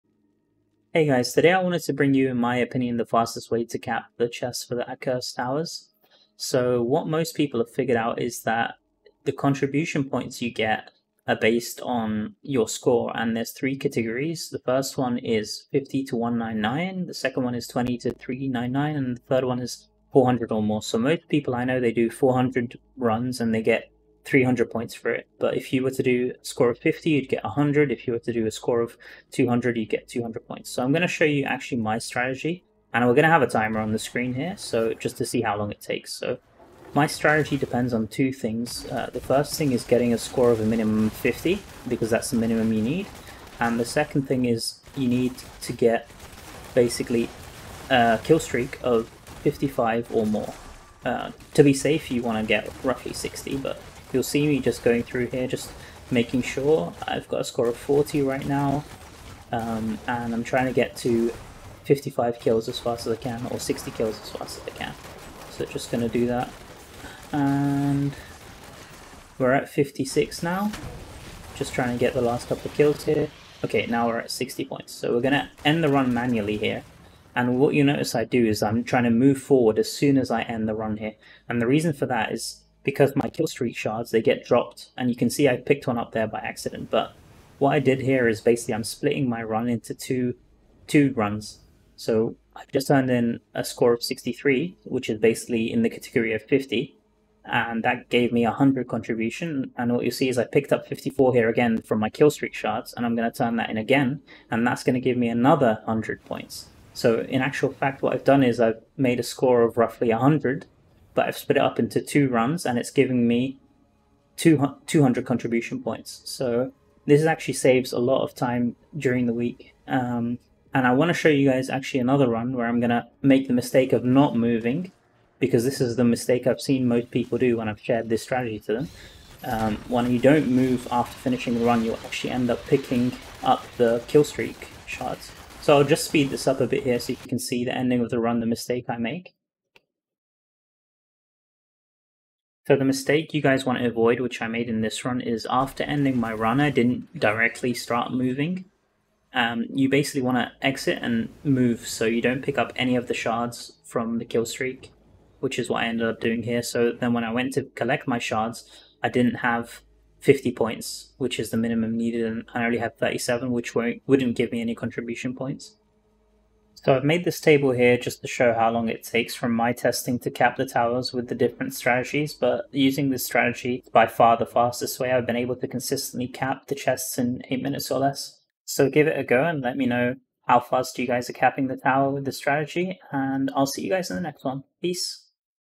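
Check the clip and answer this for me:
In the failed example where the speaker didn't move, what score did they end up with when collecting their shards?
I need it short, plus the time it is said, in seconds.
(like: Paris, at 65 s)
37, at 162 s.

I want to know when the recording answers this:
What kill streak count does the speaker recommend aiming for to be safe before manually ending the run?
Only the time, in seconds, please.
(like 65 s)
52 s.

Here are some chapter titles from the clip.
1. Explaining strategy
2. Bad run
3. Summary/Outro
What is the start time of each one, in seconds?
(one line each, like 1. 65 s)
1. 32 s
2. 123 s
3. 166 s.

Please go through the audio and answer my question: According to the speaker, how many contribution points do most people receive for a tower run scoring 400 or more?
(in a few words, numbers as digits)
300.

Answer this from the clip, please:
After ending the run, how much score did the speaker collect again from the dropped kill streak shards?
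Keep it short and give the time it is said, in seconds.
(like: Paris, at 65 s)
54, at 100 s.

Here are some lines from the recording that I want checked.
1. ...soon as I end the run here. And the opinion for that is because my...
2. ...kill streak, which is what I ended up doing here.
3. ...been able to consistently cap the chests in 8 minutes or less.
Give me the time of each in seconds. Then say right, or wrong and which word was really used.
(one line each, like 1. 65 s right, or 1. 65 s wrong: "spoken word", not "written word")
1. 79 s wrong: "reason", not "opinion"
2. 154 s right
3. 175 s right.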